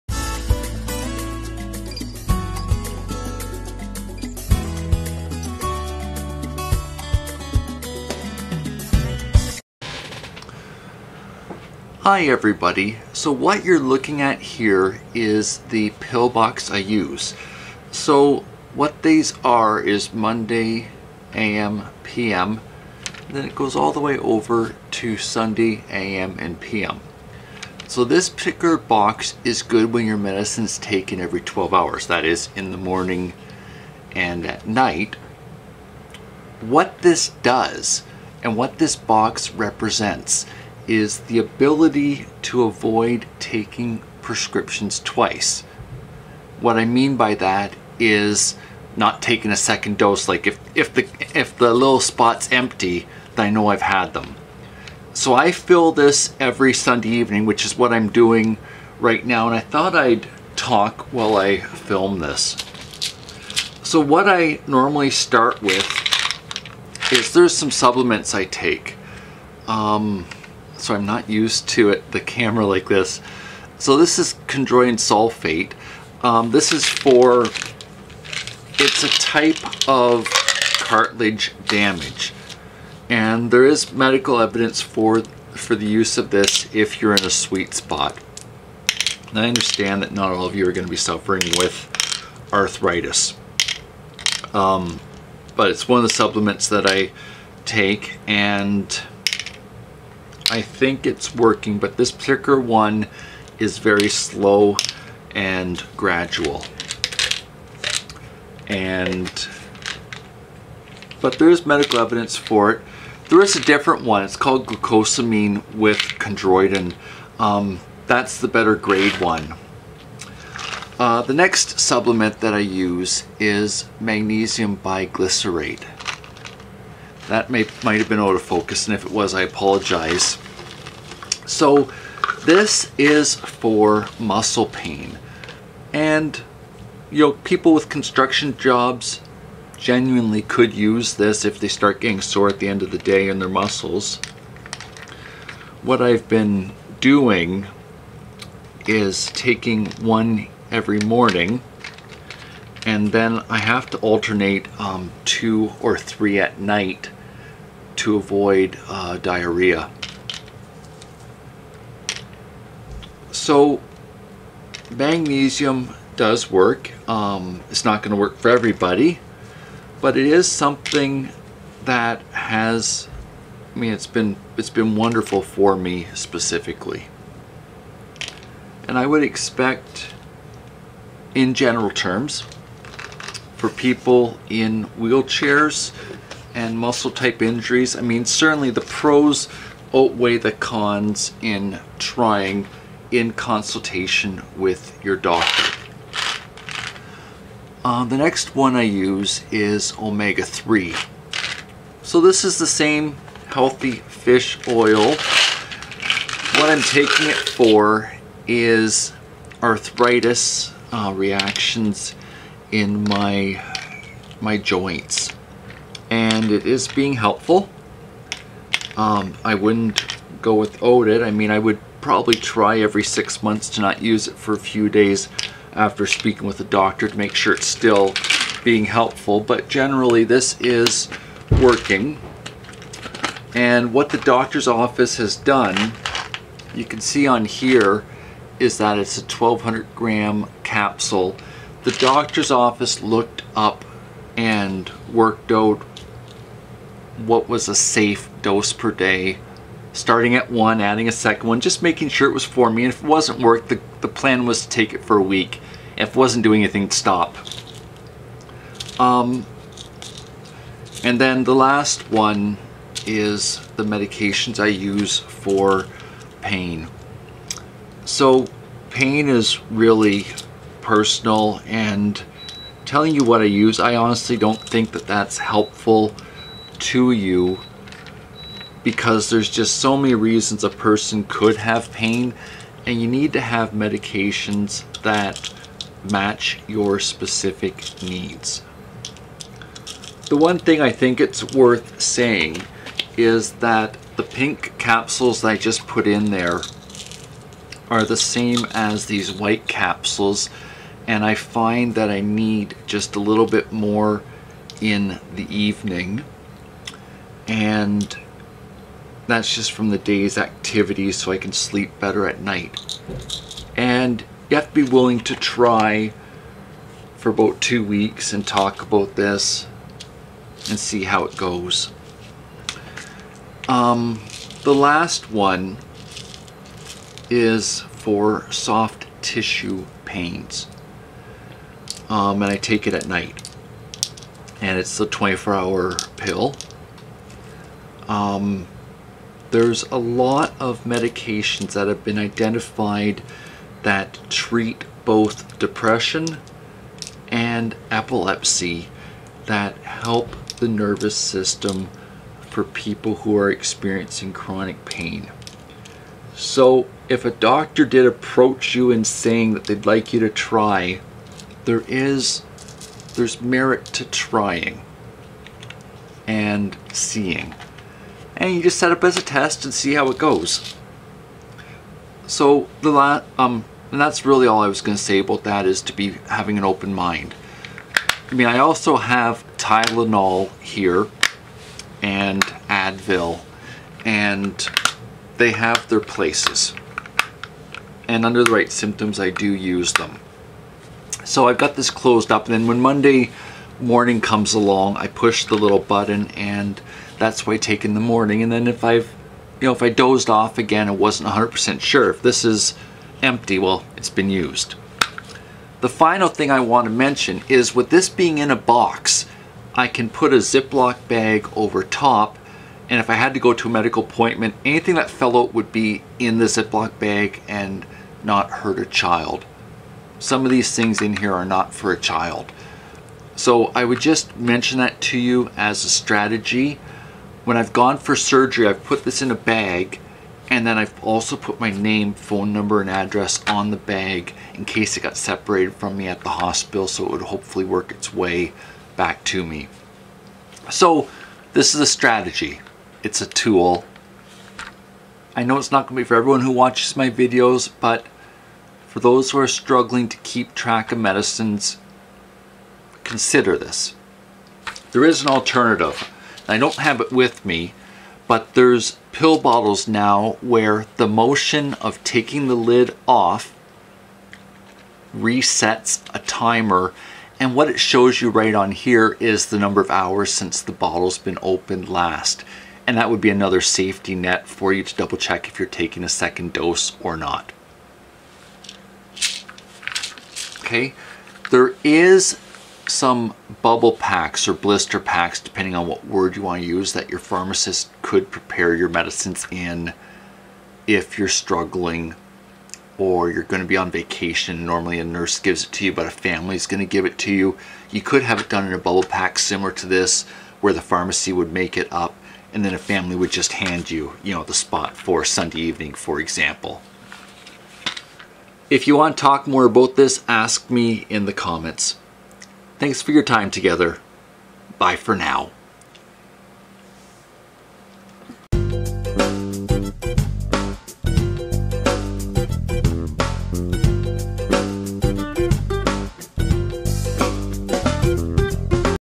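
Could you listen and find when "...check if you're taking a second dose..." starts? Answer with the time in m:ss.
7:55.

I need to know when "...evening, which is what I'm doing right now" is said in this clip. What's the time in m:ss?
0:57.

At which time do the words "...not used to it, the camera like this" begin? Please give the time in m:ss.
1:11.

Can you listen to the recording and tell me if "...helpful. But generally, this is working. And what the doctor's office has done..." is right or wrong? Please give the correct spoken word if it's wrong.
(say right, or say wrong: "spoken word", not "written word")
right.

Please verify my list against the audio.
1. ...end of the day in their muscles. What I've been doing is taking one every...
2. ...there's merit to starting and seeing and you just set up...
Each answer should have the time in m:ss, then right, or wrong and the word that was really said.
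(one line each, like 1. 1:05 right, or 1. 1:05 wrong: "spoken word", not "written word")
1. 2:22 right
2. 6:03 wrong: "trying", not "starting".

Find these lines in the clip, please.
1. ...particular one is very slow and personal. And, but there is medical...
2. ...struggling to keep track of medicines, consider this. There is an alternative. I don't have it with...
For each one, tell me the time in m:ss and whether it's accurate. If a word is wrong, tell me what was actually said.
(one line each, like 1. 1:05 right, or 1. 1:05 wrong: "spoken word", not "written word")
1. 1:42 wrong: "gradual", not "personal"
2. 7:29 right.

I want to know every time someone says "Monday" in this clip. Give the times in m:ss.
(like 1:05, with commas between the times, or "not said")
0:20, 6:32.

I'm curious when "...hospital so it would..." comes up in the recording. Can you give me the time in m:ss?
7:16.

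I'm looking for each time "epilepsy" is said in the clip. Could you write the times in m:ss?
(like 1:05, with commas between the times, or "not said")
5:47.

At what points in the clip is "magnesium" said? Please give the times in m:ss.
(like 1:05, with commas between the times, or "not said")
2:04, 2:44.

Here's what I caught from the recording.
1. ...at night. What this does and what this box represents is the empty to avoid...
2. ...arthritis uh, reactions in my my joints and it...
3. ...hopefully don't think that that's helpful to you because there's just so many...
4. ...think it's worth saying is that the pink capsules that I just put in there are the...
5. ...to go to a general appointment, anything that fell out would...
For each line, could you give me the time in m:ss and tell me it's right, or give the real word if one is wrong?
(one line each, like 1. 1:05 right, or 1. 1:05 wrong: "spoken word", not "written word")
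1. 0:34 wrong: "ability", not "empty"
2. 3:29 right
3. 4:33 wrong: "honestly", not "hopefully"
4. 4:50 right
5. 6:53 wrong: "medical", not "general".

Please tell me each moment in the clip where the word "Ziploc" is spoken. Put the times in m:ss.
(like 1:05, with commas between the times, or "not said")
6:50, 6:56.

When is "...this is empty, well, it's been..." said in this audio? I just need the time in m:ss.
6:42.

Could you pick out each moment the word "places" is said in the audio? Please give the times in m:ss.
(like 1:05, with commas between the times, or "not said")
6:25.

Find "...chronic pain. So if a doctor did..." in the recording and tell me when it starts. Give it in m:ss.
5:54.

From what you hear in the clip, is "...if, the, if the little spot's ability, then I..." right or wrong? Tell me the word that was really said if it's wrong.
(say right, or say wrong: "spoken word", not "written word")
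wrong: "empty", not "ability".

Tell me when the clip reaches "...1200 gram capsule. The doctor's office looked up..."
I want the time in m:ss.
3:59.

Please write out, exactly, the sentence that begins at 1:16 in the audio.
Um, this is for, it's a type of cartilage damage.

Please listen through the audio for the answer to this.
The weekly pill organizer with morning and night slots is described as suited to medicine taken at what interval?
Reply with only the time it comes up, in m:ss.
0:31.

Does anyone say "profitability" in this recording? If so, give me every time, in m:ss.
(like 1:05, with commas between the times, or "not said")
not said.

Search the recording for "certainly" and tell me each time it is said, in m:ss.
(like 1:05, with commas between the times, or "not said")
3:08.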